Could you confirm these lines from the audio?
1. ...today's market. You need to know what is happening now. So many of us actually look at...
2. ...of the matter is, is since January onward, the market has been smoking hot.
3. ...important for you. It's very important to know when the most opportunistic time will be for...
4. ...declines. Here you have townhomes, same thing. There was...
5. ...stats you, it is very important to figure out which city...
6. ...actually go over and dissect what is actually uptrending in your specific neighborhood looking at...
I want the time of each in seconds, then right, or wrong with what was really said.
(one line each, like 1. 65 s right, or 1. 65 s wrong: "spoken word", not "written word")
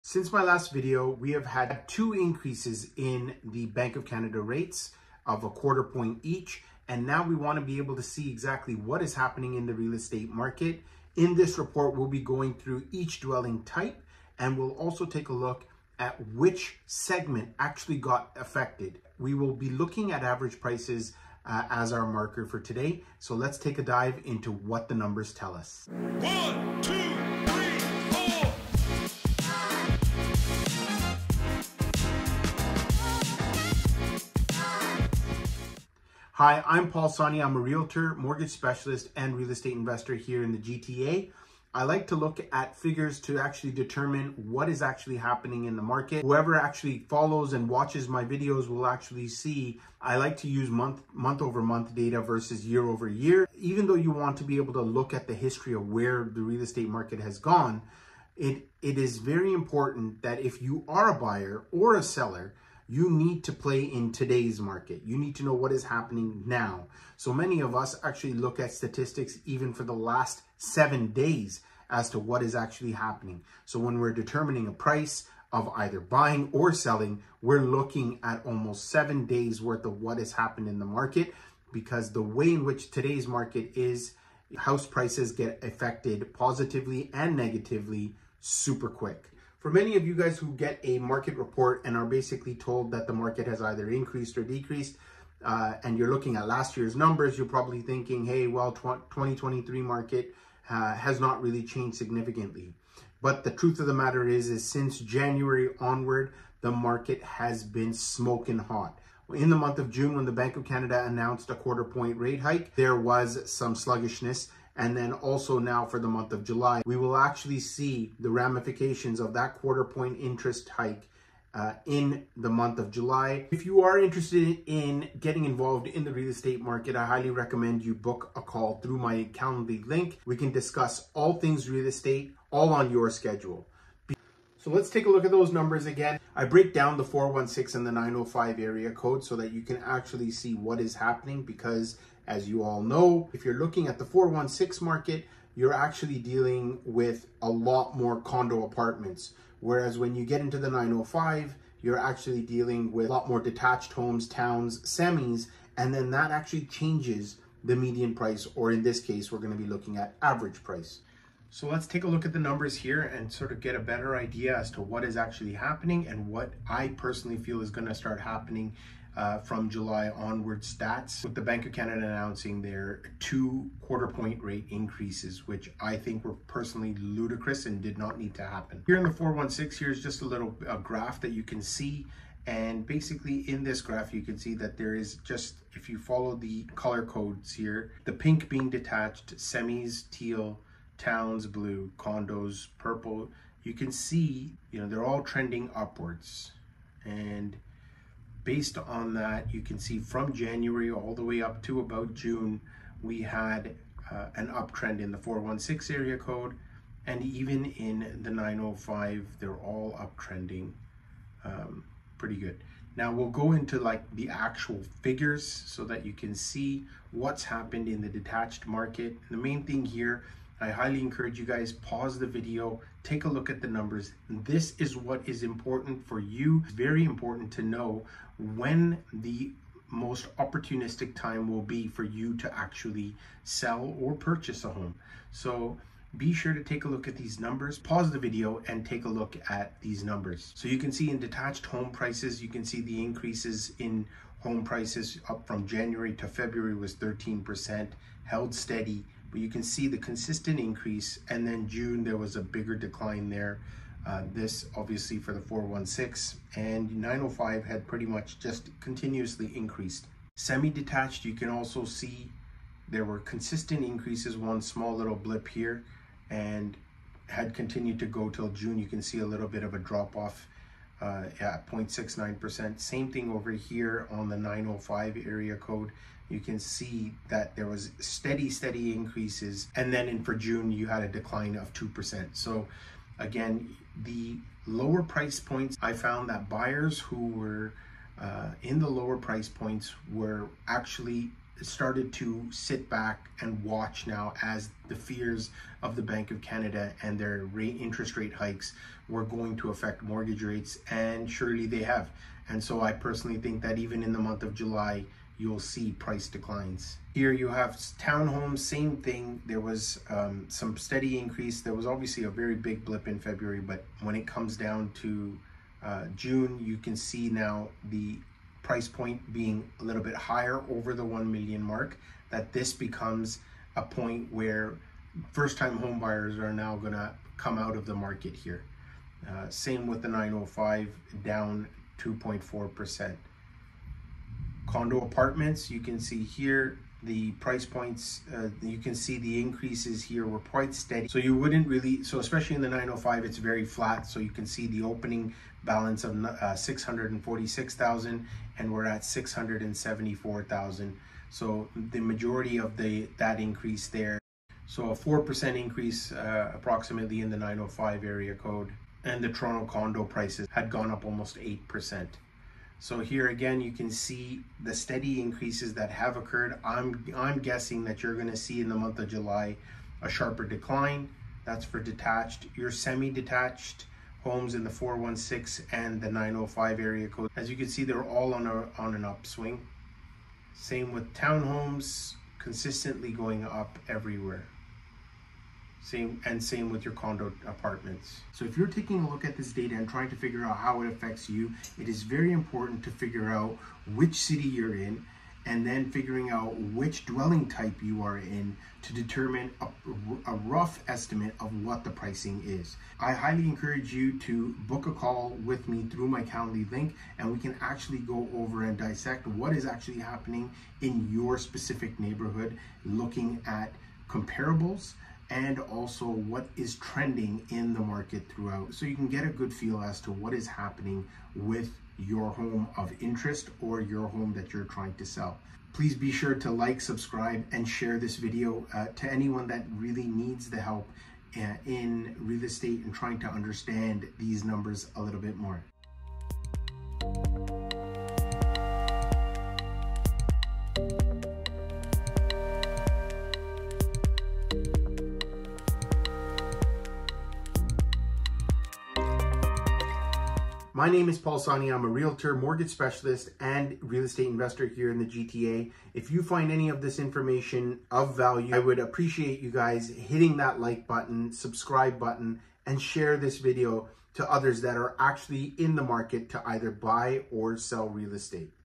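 1. 64 s right
2. 103 s right
3. 225 s right
4. 306 s right
5. 390 s wrong: "affects", not "stats"
6. 407 s wrong: "happening", not "uptrending".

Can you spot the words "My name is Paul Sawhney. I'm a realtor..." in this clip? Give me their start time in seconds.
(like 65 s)
450 s.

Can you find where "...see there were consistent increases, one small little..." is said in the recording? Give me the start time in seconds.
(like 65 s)
261 s.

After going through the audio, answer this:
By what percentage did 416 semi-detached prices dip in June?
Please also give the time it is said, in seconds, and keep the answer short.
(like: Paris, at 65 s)
0.69%, at 271 s.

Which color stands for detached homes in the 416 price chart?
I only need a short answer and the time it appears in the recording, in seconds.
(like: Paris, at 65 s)
Pink, at 188 s.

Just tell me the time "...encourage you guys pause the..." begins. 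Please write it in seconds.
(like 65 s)
221 s.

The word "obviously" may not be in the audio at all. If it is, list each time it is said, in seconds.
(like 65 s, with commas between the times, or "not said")
254 s, 311 s.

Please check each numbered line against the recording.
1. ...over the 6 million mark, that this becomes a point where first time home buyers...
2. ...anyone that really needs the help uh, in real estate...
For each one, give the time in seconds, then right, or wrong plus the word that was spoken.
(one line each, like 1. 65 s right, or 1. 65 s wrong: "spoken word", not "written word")
1. 320 s wrong: "1", not "6"
2. 429 s right.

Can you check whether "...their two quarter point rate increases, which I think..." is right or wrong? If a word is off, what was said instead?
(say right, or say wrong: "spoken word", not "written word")
right.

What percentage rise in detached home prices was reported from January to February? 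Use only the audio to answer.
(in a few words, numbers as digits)
13%.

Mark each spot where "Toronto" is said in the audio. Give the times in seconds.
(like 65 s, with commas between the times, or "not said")
359 s.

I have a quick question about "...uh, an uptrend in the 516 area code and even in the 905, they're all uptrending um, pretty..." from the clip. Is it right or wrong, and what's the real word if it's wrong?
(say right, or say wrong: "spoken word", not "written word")
wrong: "416", not "516".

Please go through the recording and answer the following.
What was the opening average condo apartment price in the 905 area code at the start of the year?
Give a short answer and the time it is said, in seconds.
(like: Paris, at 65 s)
646,000, at 346 s.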